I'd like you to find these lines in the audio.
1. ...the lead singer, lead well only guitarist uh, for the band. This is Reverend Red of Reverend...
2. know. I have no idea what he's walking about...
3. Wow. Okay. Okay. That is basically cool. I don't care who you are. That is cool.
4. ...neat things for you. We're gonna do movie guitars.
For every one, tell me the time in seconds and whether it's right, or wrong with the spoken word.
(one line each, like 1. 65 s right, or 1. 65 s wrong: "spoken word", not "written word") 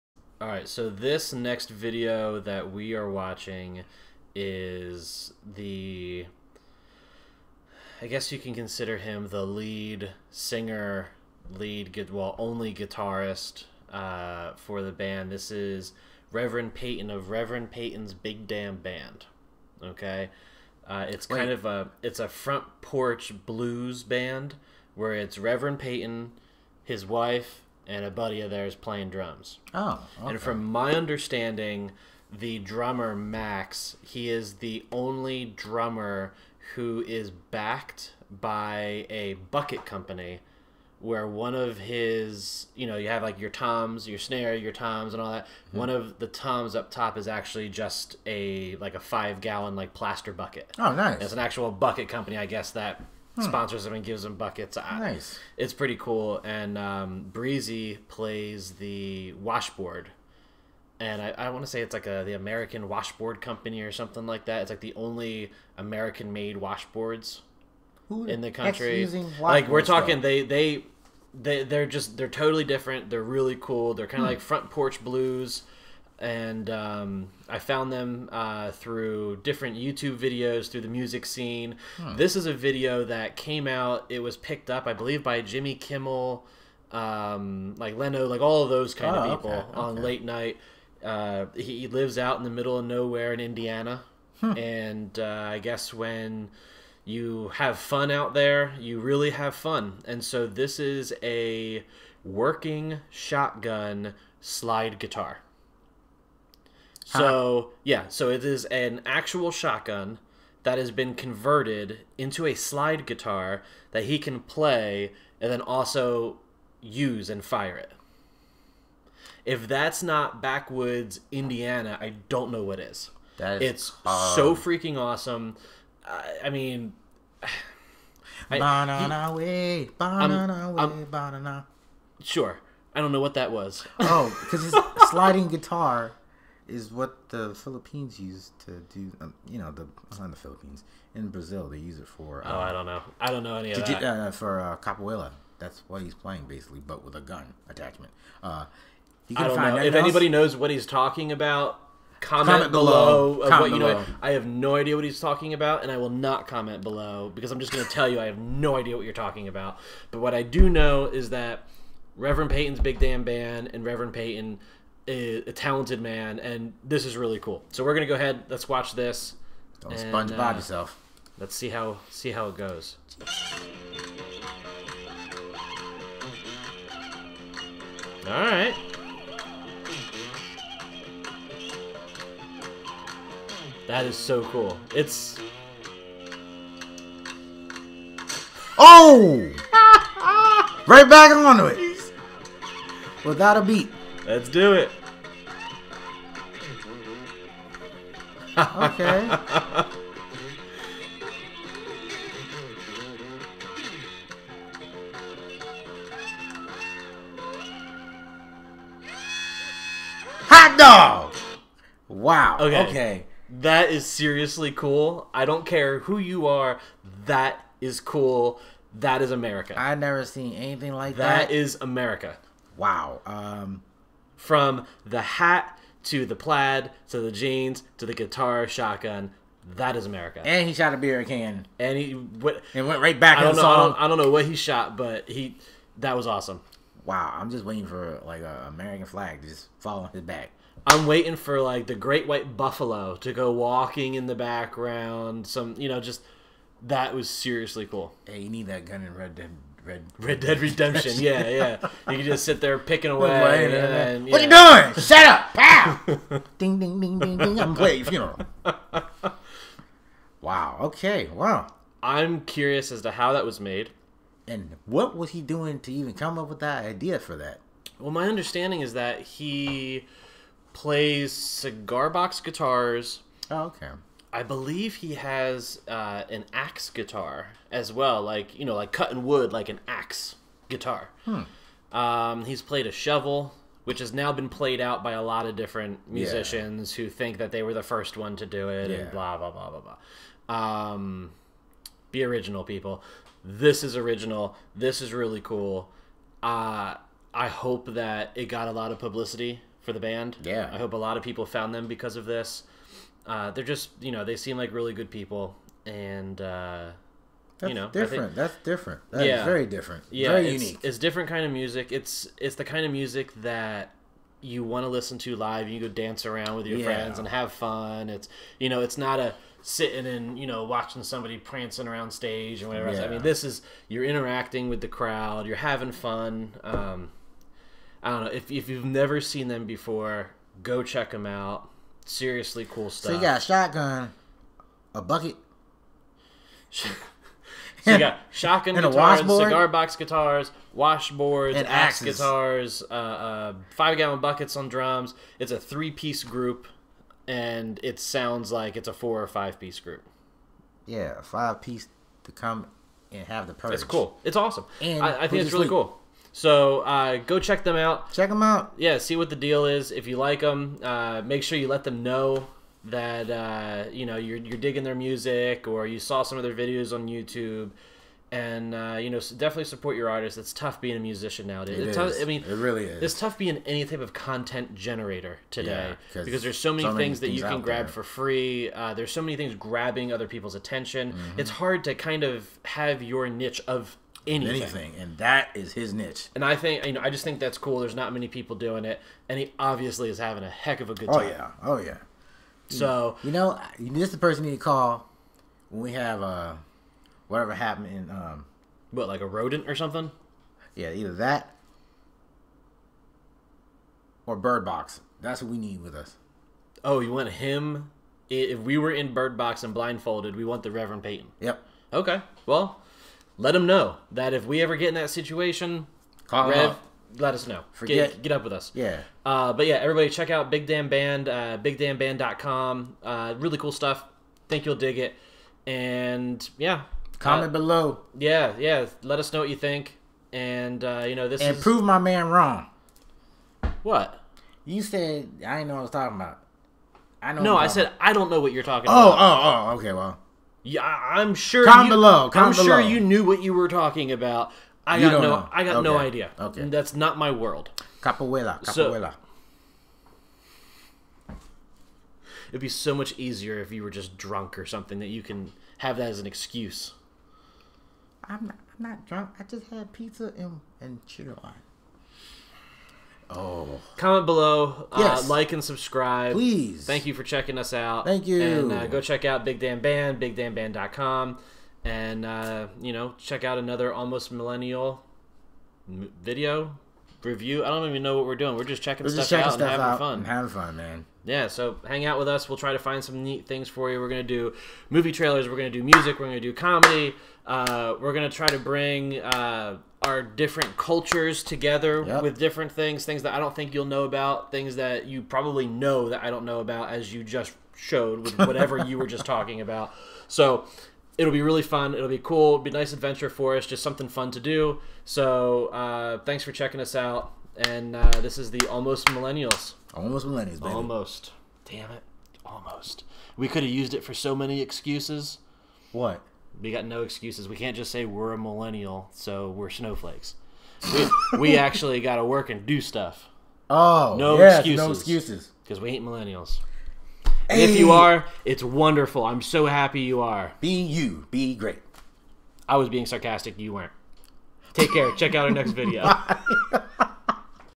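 1. 9 s wrong: "Peyton", not "Red"
2. 154 s wrong: "talking", not "walking"
3. 212 s wrong: "seriously", not "basically"
4. 483 s wrong: "trailers", not "guitars".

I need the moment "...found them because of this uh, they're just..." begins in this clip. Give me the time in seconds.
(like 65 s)
301 s.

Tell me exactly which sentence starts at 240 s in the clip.
I'm waiting for like the great white buffalo to go walking in the background.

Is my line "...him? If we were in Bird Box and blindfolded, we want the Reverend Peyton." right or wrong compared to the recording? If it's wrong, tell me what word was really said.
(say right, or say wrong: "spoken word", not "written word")
right.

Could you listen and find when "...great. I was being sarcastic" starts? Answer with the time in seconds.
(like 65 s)
531 s.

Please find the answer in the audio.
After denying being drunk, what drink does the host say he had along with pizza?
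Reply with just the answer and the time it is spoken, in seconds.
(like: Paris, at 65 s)
chili wine, at 461 s.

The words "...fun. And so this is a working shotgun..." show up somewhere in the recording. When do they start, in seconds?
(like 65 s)
99 s.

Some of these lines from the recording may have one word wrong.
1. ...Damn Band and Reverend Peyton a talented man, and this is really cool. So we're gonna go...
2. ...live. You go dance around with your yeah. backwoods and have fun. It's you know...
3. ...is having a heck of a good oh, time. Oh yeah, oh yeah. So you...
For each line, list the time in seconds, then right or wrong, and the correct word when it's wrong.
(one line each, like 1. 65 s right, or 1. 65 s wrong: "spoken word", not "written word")
1. 162 s right
2. 315 s wrong: "friends", not "backwoods"
3. 390 s right.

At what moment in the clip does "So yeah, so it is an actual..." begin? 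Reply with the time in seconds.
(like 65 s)
107 s.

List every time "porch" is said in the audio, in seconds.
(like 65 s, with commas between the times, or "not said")
22 s, 74 s.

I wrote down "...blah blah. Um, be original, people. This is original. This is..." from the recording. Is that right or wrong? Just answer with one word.
right.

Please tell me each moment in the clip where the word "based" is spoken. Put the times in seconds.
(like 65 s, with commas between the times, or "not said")
not said.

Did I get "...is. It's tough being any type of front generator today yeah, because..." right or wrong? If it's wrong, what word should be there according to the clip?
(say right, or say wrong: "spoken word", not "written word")
wrong: "content", not "front".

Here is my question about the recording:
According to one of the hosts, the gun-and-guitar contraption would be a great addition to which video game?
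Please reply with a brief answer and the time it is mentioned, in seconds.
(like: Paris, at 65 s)
Red Dead Redemption, at 250 s.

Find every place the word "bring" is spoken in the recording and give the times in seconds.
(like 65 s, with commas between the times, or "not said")
488 s.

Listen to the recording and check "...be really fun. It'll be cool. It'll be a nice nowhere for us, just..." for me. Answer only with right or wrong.
wrong.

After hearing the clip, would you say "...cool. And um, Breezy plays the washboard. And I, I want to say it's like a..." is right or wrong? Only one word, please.
right.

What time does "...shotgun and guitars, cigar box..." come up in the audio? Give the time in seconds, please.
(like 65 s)
338 s.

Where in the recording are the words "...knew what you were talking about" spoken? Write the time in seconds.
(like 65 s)
442 s.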